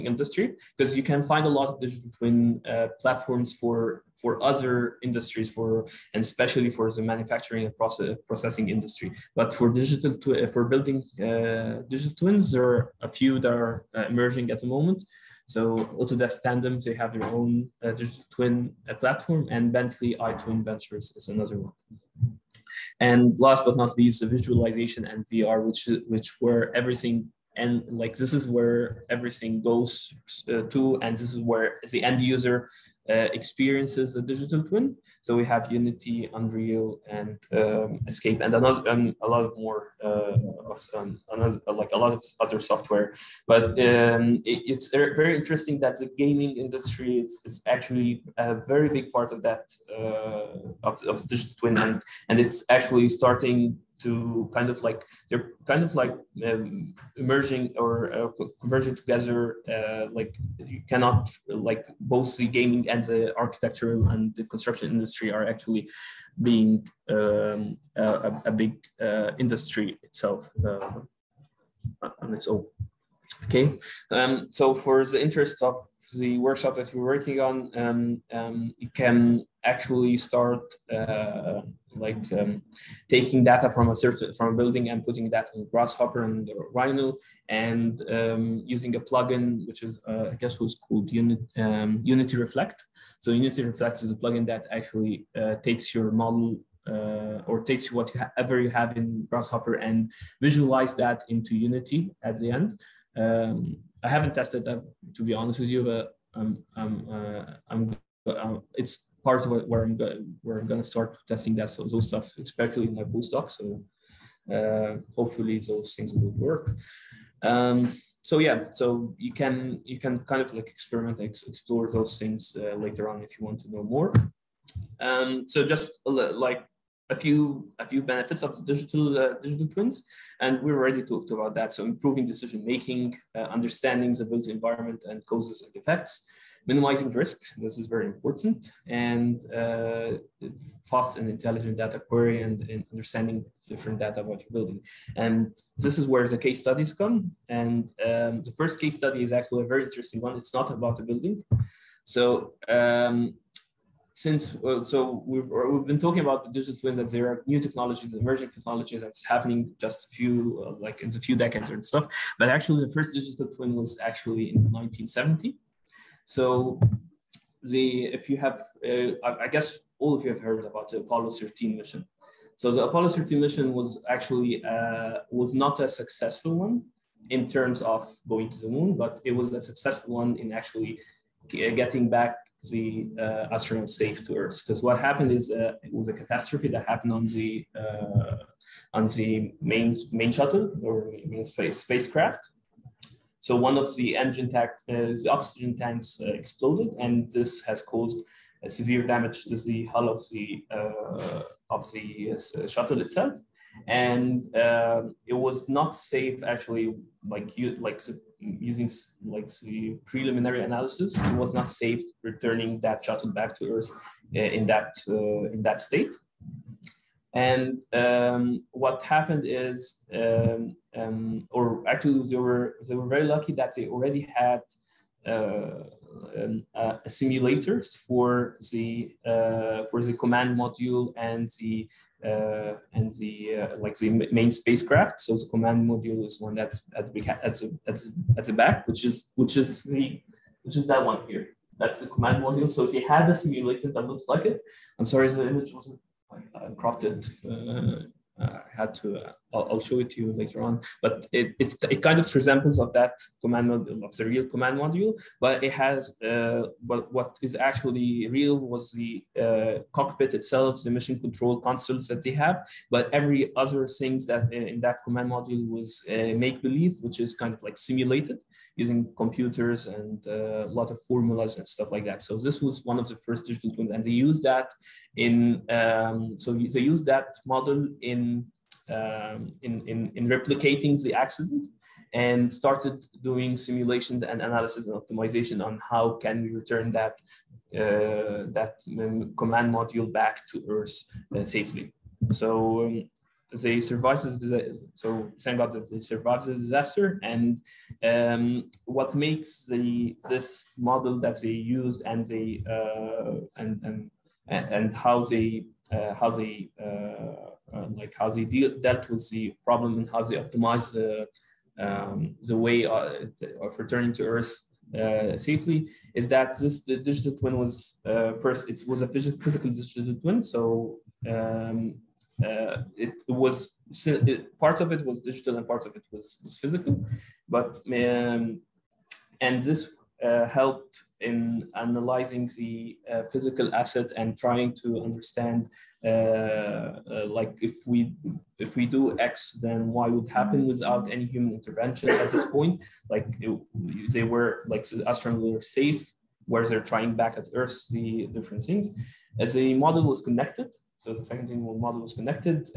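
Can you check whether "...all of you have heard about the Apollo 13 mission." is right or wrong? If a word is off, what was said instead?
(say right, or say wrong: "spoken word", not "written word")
right.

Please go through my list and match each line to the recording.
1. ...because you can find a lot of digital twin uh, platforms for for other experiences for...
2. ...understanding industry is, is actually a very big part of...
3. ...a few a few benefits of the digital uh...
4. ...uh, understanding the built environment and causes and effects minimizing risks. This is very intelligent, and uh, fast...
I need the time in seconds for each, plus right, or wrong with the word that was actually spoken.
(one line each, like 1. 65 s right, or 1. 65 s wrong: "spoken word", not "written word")
1. 0 s wrong: "industries", not "experiences"
2. 46 s wrong: "gaming", not "understanding"
3. 127 s right
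4. 133 s wrong: "important", not "intelligent".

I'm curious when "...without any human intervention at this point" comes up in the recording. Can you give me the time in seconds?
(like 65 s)
340 s.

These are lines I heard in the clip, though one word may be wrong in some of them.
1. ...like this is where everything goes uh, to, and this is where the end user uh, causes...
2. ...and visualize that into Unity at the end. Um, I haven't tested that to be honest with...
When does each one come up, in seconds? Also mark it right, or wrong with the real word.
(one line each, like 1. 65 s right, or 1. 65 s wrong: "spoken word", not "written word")
1. 27 s wrong: "experiences", not "causes"
2. 99 s right.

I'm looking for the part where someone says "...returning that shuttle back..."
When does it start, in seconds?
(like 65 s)
212 s.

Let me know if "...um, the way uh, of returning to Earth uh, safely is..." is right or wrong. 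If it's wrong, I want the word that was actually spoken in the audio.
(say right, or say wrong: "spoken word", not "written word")
right.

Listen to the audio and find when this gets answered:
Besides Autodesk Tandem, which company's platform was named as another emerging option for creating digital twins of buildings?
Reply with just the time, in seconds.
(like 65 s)
19 s.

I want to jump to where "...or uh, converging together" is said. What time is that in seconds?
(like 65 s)
57 s.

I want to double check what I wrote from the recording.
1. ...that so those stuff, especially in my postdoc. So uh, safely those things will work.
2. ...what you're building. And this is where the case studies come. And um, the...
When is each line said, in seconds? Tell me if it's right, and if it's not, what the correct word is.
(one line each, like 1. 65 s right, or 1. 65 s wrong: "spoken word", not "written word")
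1. 111 s wrong: "hopefully", not "safely"
2. 144 s right.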